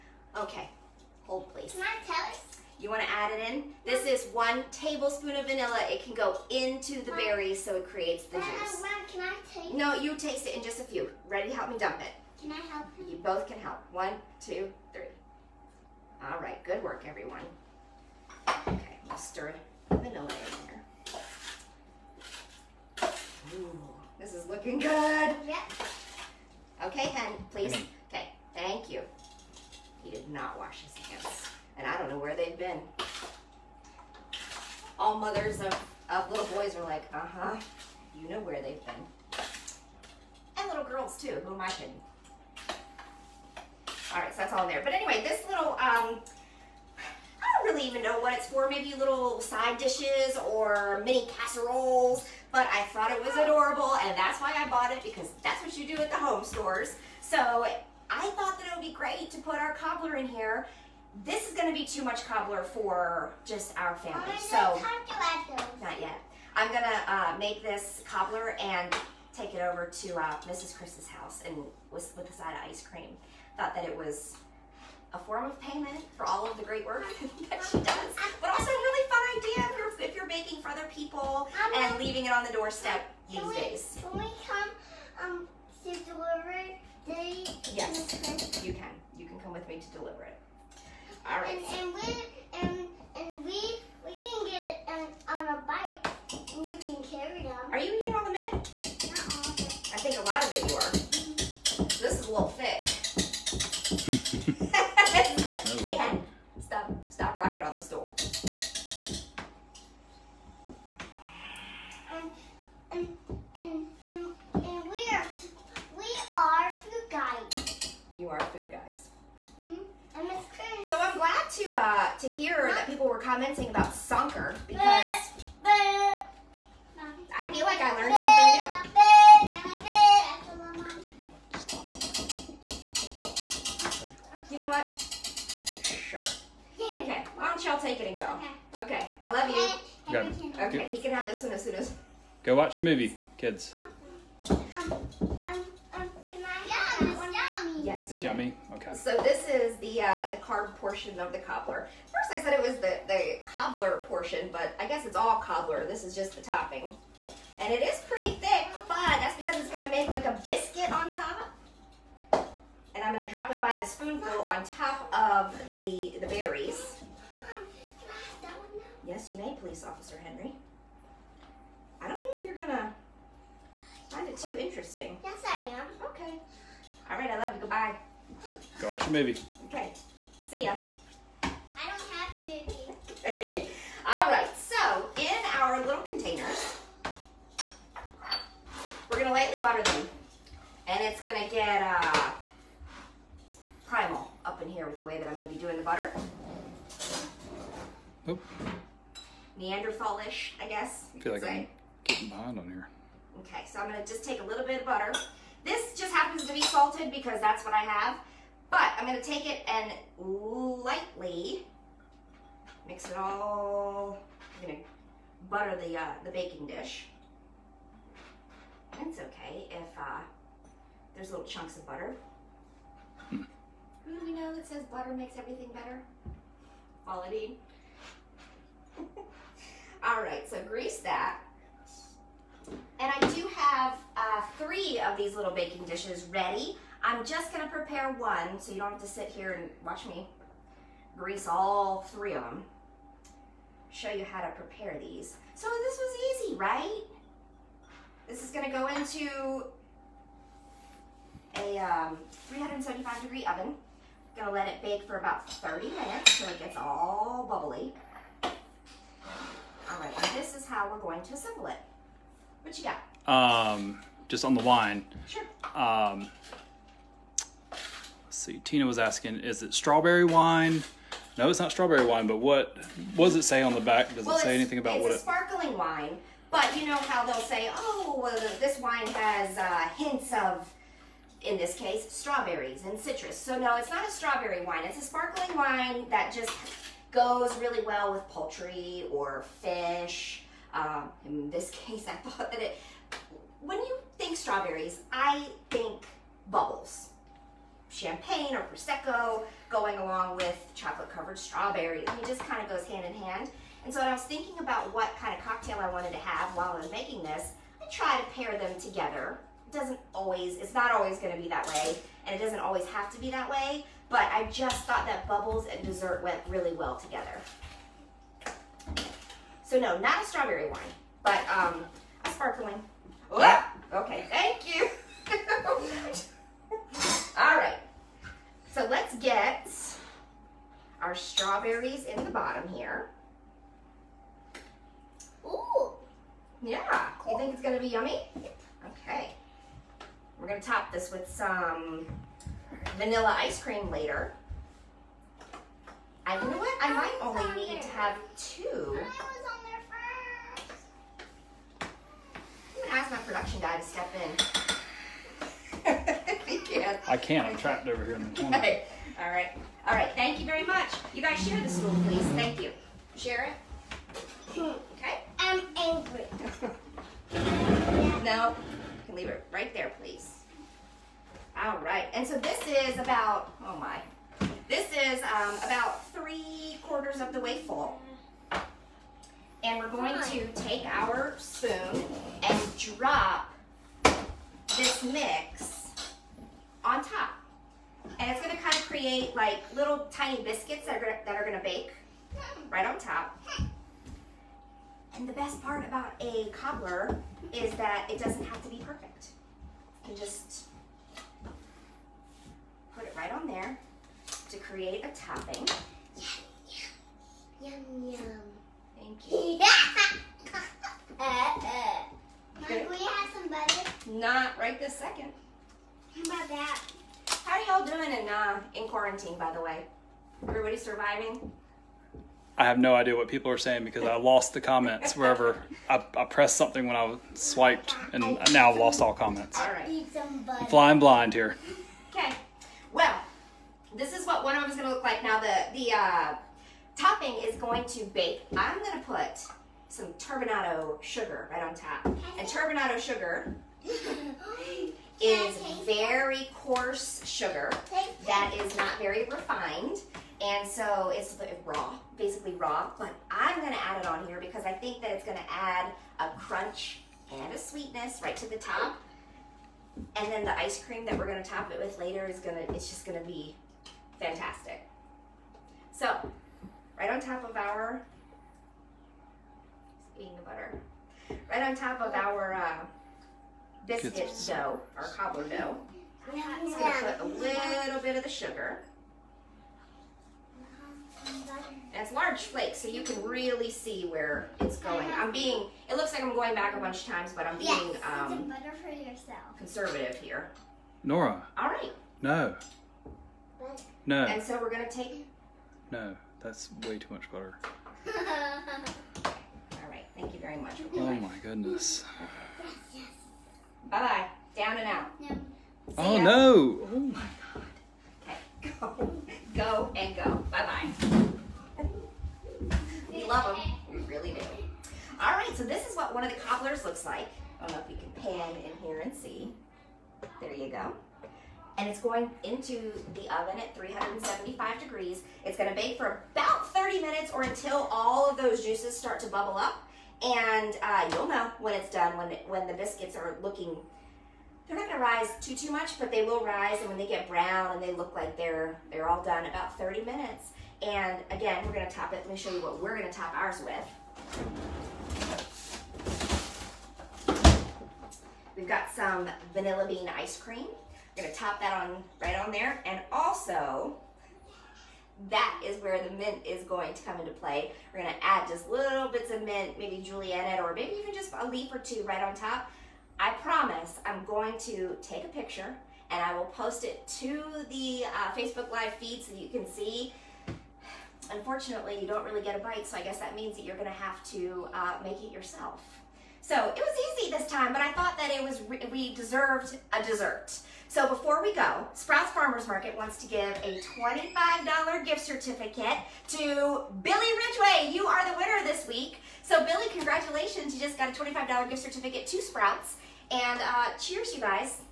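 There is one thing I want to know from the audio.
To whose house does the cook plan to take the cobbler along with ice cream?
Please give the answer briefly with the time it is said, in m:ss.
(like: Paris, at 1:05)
Mrs. Chris, at 1:10.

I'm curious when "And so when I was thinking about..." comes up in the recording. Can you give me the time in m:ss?
5:03.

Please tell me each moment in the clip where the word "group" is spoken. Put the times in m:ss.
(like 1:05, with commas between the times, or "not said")
not said.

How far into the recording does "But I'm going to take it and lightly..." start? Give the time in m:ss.
3:28.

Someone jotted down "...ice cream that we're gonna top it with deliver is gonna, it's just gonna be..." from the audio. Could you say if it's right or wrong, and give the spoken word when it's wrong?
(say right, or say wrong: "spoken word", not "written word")
wrong: "later", not "deliver".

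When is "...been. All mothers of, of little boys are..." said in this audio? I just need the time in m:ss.
0:32.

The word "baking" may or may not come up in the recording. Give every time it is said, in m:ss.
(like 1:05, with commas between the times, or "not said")
1:20, 3:36, 3:55.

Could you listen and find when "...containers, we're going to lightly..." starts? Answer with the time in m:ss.
3:06.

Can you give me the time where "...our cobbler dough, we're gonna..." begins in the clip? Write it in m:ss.
7:54.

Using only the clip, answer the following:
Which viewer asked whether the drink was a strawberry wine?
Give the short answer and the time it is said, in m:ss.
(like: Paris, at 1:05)
Tina, at 4:28.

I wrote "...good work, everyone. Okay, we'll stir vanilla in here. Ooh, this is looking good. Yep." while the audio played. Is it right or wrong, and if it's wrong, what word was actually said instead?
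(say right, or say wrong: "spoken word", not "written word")
right.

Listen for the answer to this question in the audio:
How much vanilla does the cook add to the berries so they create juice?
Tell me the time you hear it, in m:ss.
0:04.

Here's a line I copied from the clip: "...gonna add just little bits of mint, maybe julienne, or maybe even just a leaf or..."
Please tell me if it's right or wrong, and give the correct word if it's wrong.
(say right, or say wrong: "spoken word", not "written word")
right.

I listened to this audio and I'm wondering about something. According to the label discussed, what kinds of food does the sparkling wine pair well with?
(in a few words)
Poultry or fish.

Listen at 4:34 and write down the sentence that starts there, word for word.
Does well, it say anything about what it?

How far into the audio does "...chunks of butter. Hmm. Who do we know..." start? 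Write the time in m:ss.
3:41.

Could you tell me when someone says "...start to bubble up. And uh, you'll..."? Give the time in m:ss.
8:48.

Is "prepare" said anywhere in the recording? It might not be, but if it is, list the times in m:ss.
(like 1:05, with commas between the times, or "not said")
3:57, 4:04.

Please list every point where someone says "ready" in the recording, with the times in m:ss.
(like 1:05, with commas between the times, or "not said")
0:11, 3:56.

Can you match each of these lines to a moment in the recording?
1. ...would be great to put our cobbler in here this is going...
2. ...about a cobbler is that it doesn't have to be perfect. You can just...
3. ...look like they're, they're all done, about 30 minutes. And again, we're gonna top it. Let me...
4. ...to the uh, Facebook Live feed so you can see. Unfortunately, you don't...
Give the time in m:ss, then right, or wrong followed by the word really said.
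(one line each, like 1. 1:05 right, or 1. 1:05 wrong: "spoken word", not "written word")
1. 0:58 right
2. 6:35 right
3. 8:57 right
4. 9:27 right.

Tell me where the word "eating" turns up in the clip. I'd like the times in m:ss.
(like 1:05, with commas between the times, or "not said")
1:38, 7:50.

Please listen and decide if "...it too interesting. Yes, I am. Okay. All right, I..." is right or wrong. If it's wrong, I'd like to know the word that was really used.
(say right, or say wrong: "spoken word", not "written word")
right.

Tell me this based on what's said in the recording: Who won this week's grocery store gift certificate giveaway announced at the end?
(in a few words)
Billy Ridgway.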